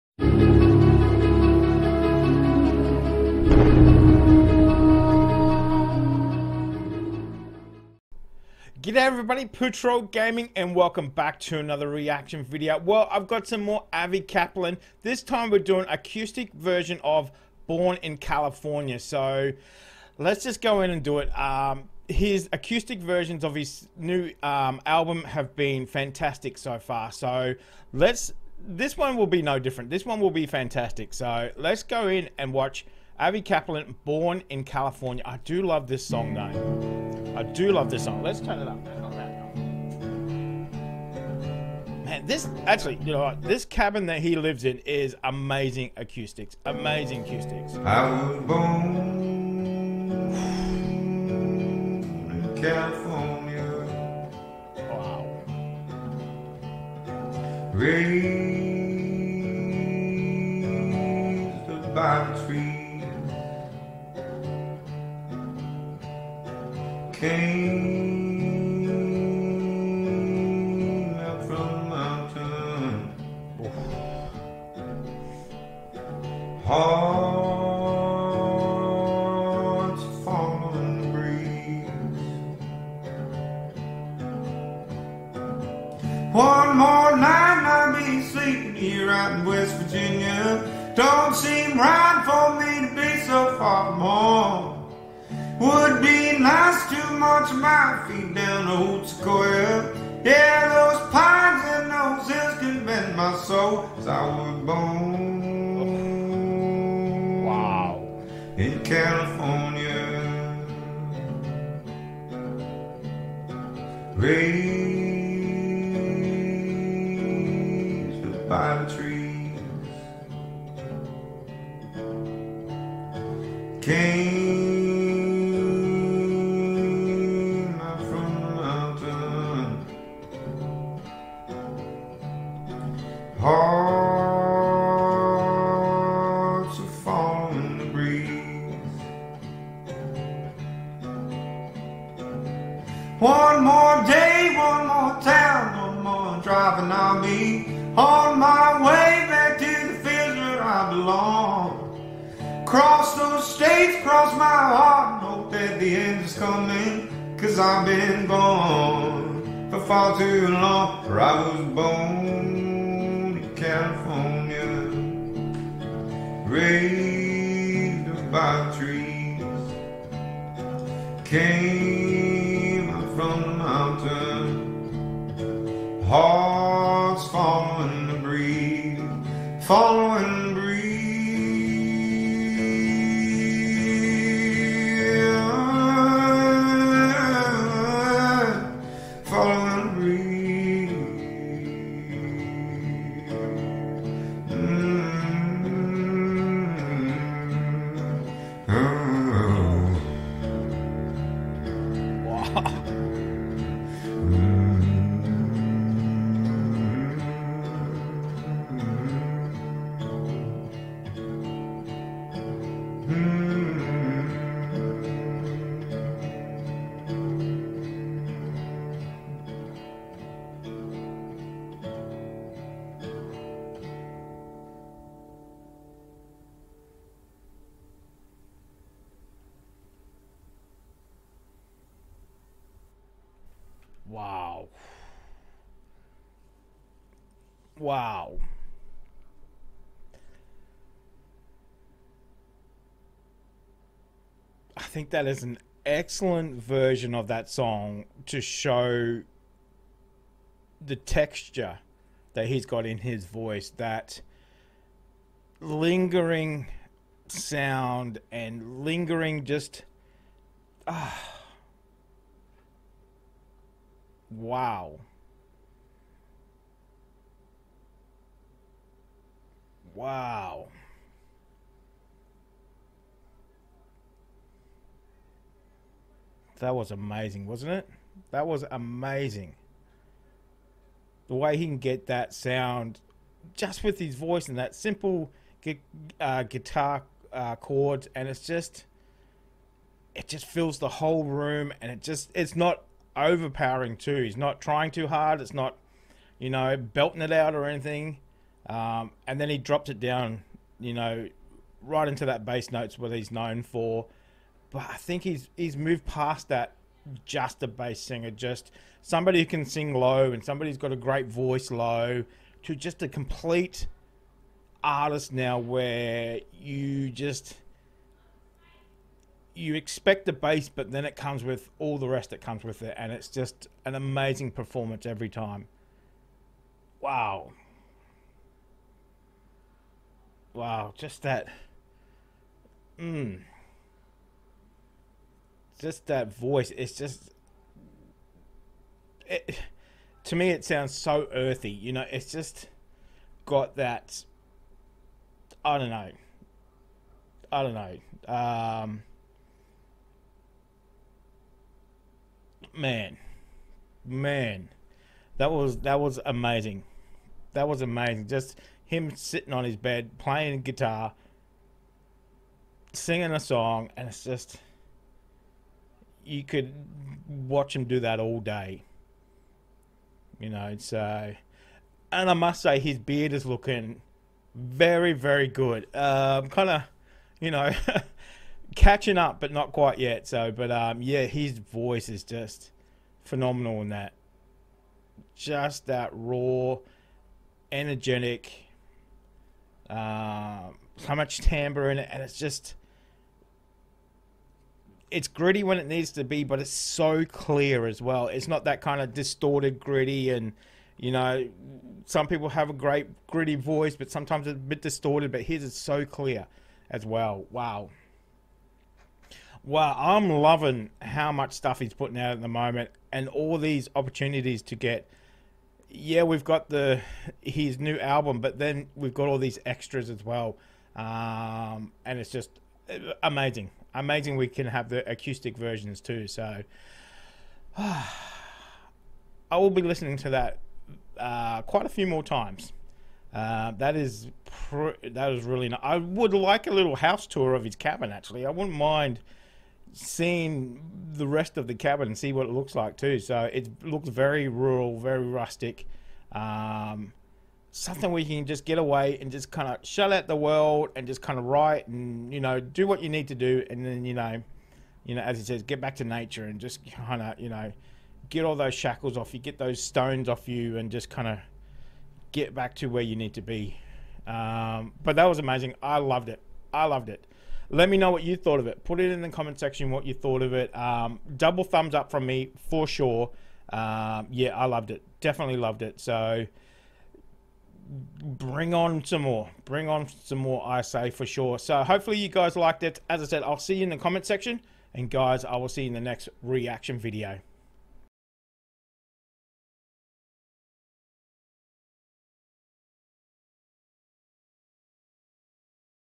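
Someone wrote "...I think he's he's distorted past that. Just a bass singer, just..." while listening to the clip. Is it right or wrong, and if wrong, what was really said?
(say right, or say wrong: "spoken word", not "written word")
wrong: "moved", not "distorted".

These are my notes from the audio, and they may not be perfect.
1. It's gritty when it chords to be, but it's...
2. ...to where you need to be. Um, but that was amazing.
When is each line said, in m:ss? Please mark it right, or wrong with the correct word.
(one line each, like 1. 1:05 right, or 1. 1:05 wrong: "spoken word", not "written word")
1. 6:35 wrong: "needs", not "chords"
2. 7:42 right.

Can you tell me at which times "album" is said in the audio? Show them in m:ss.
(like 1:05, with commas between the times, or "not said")
0:24, 6:57.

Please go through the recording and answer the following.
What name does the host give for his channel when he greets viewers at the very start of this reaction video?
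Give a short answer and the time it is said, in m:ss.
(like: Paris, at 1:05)
Patrol Gaming, at 0:09.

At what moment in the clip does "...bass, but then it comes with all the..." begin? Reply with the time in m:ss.
5:20.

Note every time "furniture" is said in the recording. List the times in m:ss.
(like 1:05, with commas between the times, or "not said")
not said.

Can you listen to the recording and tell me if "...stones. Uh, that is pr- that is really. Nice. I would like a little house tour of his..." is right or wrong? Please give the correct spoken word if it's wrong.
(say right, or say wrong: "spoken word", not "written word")
wrong: "times", not "stones".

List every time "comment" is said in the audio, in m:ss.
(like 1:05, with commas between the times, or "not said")
7:49, 8:03.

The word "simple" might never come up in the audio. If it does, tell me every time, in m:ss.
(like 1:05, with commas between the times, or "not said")
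4:44.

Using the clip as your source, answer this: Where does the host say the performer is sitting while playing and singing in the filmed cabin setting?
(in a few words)
his bed.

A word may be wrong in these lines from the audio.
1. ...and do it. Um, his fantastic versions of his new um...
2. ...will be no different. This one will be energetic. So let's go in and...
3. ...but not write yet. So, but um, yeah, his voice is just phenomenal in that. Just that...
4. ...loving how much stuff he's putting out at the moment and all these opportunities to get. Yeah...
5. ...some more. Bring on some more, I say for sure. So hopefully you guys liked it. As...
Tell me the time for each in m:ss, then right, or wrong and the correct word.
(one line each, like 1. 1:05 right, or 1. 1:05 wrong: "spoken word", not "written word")
1. 0:20 wrong: "acoustic", not "fantastic"
2. 0:29 wrong: "fantastic", not "energetic"
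3. 6:19 wrong: "quite", not "write"
4. 6:50 right
5. 7:59 right.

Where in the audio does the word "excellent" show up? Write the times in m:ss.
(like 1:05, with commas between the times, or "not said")
4:05.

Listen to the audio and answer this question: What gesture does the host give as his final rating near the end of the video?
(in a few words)
double thumbs up.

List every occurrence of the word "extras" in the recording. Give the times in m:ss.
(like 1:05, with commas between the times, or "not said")
6:59.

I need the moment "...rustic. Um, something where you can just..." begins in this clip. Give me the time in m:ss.
7:25.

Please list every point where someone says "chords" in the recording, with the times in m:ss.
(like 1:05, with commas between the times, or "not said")
4:47.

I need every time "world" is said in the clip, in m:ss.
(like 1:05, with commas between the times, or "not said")
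7:30.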